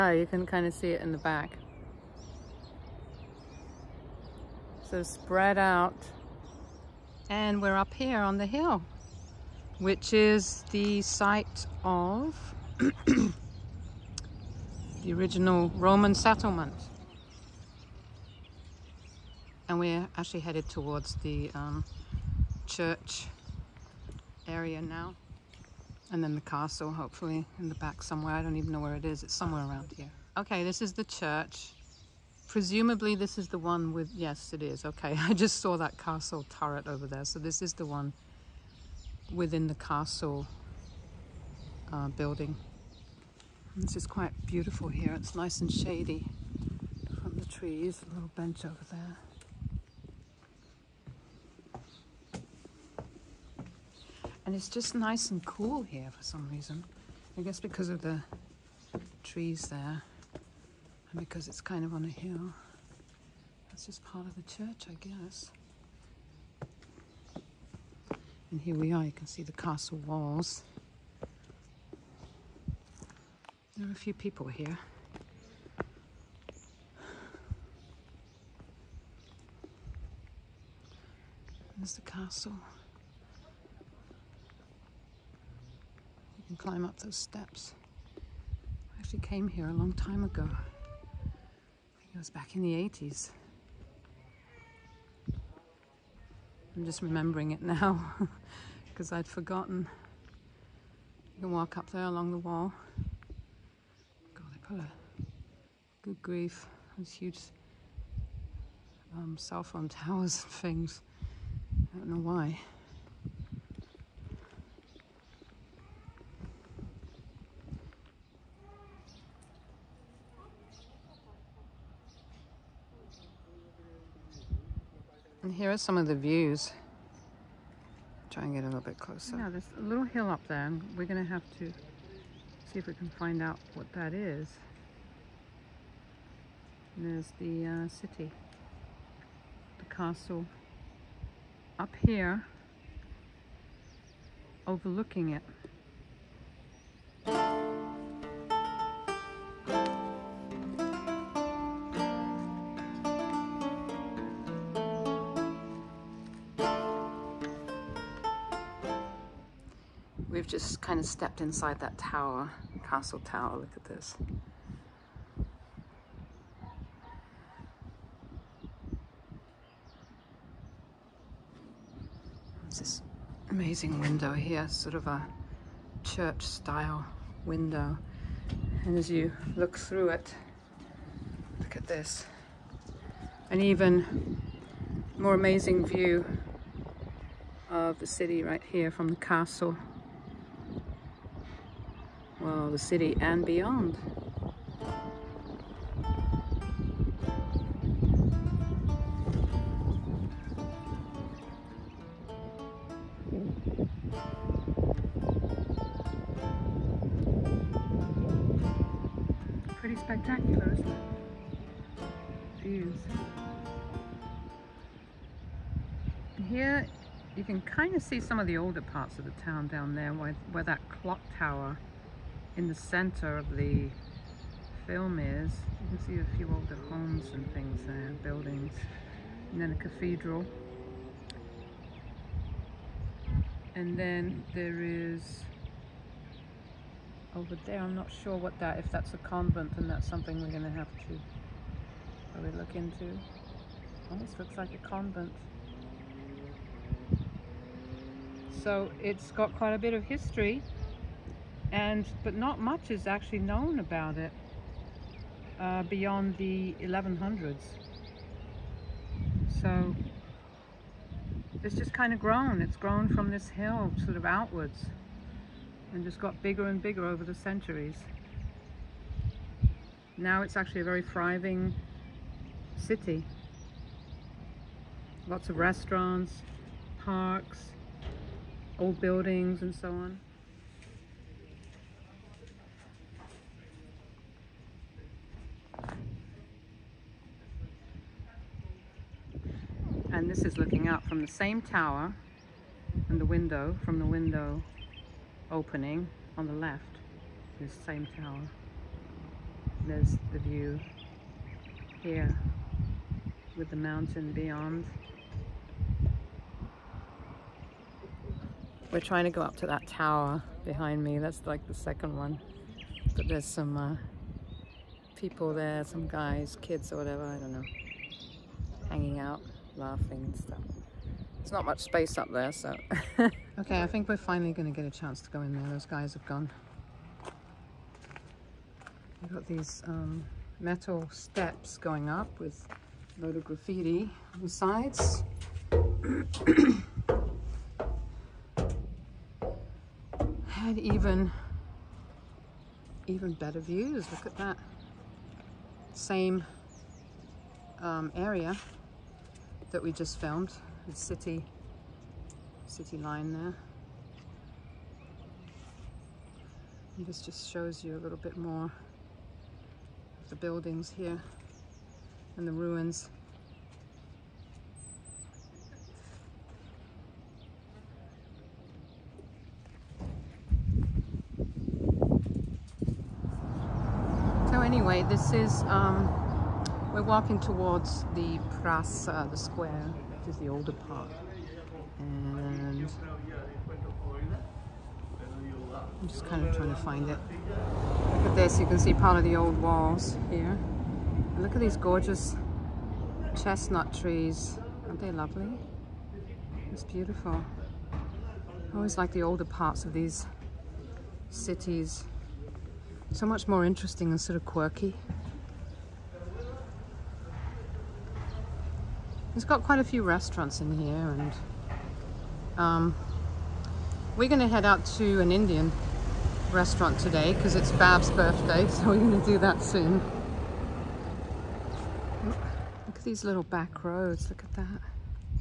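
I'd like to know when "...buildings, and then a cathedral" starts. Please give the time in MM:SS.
03:48.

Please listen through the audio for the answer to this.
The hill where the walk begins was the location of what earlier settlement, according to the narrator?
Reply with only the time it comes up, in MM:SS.
00:15.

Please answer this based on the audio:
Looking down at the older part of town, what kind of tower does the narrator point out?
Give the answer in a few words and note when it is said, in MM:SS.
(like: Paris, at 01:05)
clock tower, at 03:40.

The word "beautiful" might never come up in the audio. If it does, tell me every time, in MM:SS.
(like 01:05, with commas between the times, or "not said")
00:44, 06:36.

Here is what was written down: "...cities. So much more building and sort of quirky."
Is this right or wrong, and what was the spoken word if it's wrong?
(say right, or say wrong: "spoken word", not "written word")
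wrong: "interesting", not "building".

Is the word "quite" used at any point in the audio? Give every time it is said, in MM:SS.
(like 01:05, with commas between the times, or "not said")
00:44, 04:09, 06:49.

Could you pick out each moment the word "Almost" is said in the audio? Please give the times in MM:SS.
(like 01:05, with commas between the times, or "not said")
04:04.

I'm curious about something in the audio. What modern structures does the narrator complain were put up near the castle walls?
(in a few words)
cell phone towers.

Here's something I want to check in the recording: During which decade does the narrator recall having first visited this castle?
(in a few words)
the 80s.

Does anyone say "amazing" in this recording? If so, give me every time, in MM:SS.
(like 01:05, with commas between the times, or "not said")
02:53, 03:05.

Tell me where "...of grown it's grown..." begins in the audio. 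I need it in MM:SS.
04:22.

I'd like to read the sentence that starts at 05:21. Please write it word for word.
There's not much space up there, so.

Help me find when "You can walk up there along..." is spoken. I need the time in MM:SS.
01:41.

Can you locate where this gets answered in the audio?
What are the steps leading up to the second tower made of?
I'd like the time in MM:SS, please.
05:30.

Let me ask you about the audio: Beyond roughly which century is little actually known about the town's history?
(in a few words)
the 1100s.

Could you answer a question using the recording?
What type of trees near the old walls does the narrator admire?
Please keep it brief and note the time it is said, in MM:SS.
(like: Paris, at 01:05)
chestnut trees, at 06:33.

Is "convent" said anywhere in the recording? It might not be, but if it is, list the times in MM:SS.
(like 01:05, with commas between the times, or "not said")
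03:59, 04:04.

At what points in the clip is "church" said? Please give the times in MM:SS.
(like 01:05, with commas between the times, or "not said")
00:22, 00:31, 01:04, 02:56.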